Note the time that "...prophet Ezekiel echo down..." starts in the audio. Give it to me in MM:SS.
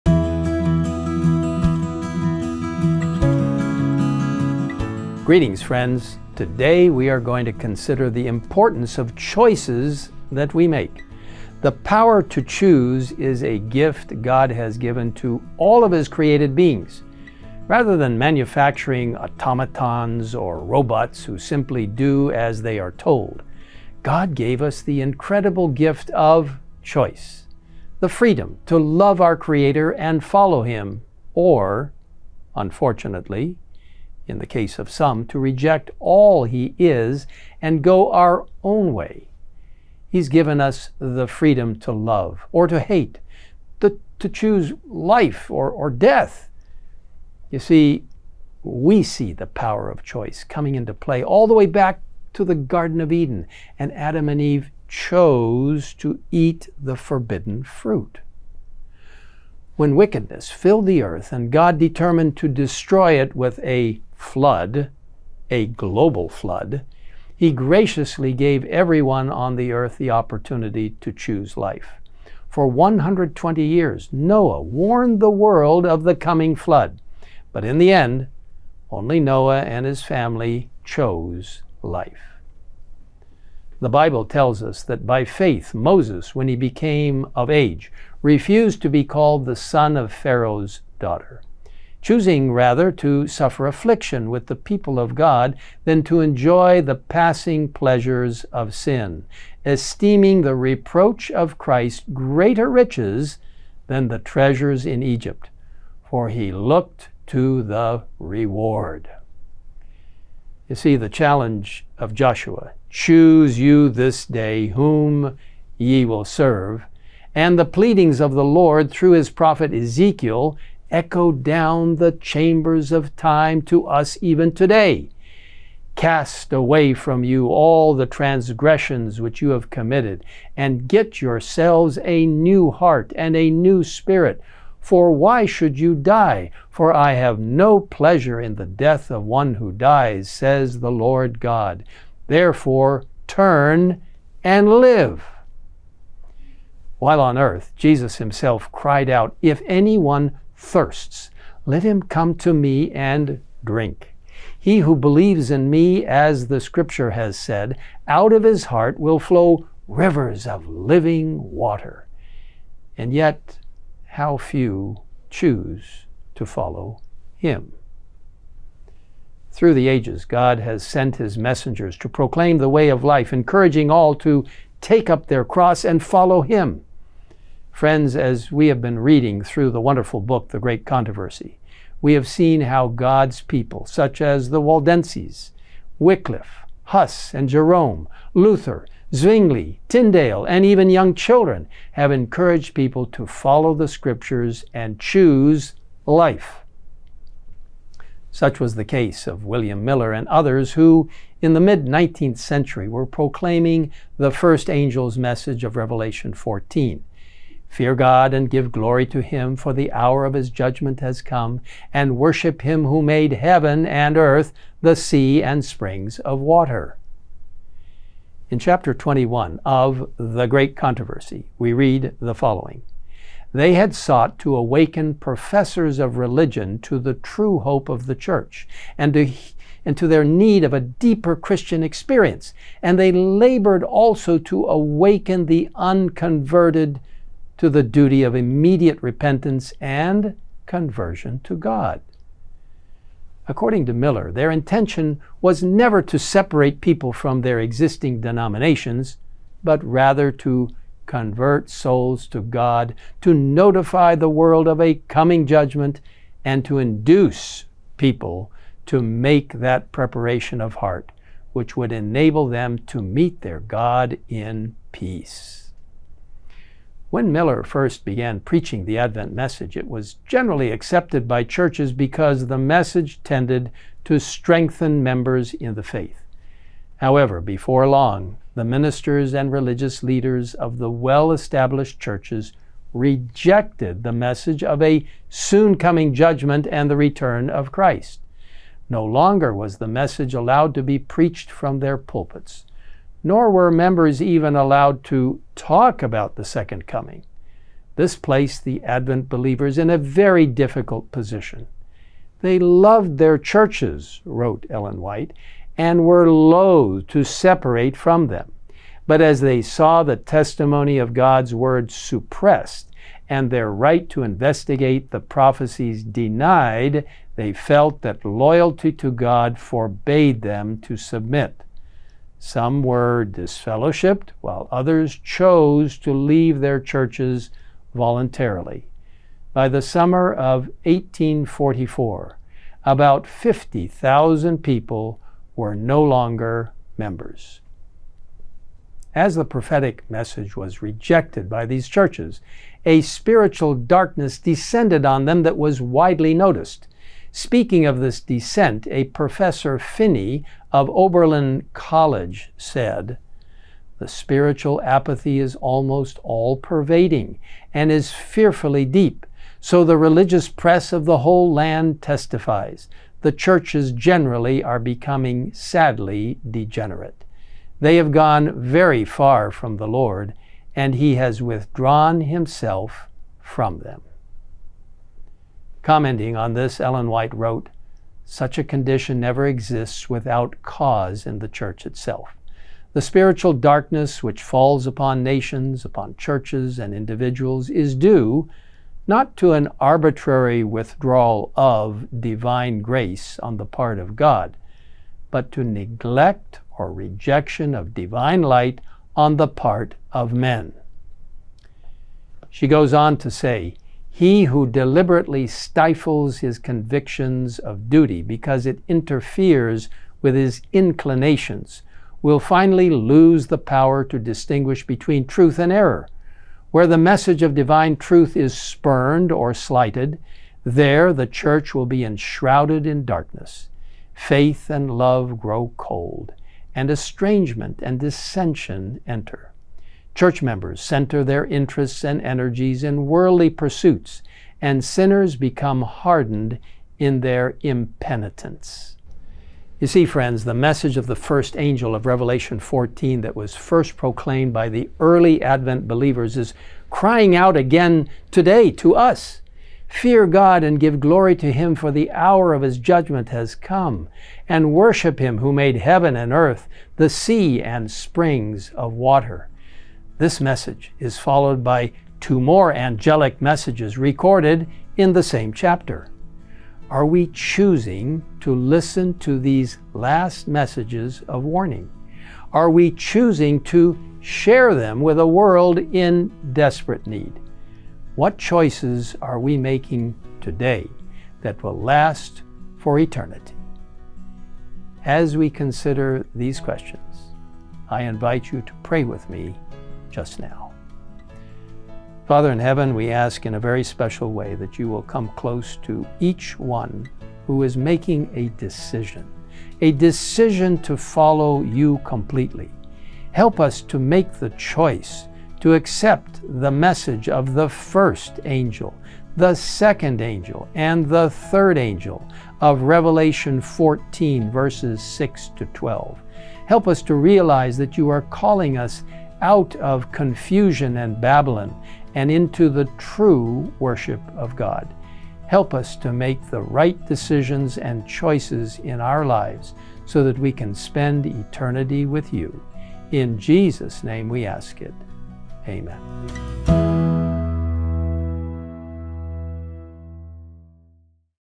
01:59.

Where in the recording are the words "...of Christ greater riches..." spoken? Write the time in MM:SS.
01:41.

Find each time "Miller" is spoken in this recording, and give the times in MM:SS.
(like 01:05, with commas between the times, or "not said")
03:19, 04:03, 04:27.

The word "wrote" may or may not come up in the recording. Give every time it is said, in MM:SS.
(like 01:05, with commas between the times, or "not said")
05:04, 06:17.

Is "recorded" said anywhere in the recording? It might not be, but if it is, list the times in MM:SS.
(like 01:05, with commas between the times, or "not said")
07:43.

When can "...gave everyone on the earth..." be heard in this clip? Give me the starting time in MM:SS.
01:08.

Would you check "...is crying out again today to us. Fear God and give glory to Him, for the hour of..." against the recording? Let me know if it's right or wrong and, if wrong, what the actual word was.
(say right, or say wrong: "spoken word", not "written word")
right.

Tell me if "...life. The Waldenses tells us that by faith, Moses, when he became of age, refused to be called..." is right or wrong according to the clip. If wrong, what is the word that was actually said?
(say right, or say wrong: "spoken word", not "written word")
wrong: "Bible", not "Waldenses".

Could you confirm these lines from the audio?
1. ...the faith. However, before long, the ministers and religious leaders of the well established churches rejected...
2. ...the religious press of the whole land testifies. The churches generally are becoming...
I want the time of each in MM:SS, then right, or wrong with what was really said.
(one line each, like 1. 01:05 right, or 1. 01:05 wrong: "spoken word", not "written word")
1. 04:35 right
2. 05:59 right.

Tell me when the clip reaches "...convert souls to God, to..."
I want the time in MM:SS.
04:11.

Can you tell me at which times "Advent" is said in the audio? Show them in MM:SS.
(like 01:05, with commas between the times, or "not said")
04:28, 04:58, 07:25.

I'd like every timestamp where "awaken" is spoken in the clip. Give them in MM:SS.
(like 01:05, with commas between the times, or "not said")
03:44, 03:54.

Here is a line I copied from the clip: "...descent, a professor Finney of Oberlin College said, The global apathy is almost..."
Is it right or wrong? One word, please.
wrong.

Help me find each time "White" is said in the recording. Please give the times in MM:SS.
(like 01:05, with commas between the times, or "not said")
05:05, 06:17.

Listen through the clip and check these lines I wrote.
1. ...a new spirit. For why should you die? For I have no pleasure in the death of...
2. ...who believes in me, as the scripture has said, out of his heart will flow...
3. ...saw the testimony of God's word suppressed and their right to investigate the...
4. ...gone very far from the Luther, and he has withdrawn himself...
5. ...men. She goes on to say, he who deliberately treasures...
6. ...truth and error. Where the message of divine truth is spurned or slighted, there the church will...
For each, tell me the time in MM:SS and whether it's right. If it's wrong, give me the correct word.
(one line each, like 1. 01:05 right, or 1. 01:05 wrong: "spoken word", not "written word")
1. 02:13 right
2. 02:34 right
3. 05:09 right
4. 06:08 wrong: "Lord", not "Luther"
5. 06:40 wrong: "stifles", not "treasures"
6. 06:55 right.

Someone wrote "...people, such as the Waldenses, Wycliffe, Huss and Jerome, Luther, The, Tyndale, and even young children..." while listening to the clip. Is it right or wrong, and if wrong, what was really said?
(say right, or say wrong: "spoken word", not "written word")
wrong: "Zwingli", not "The".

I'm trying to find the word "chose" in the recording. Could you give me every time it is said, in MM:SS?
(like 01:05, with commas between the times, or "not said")
00:54, 01:20, 05:25.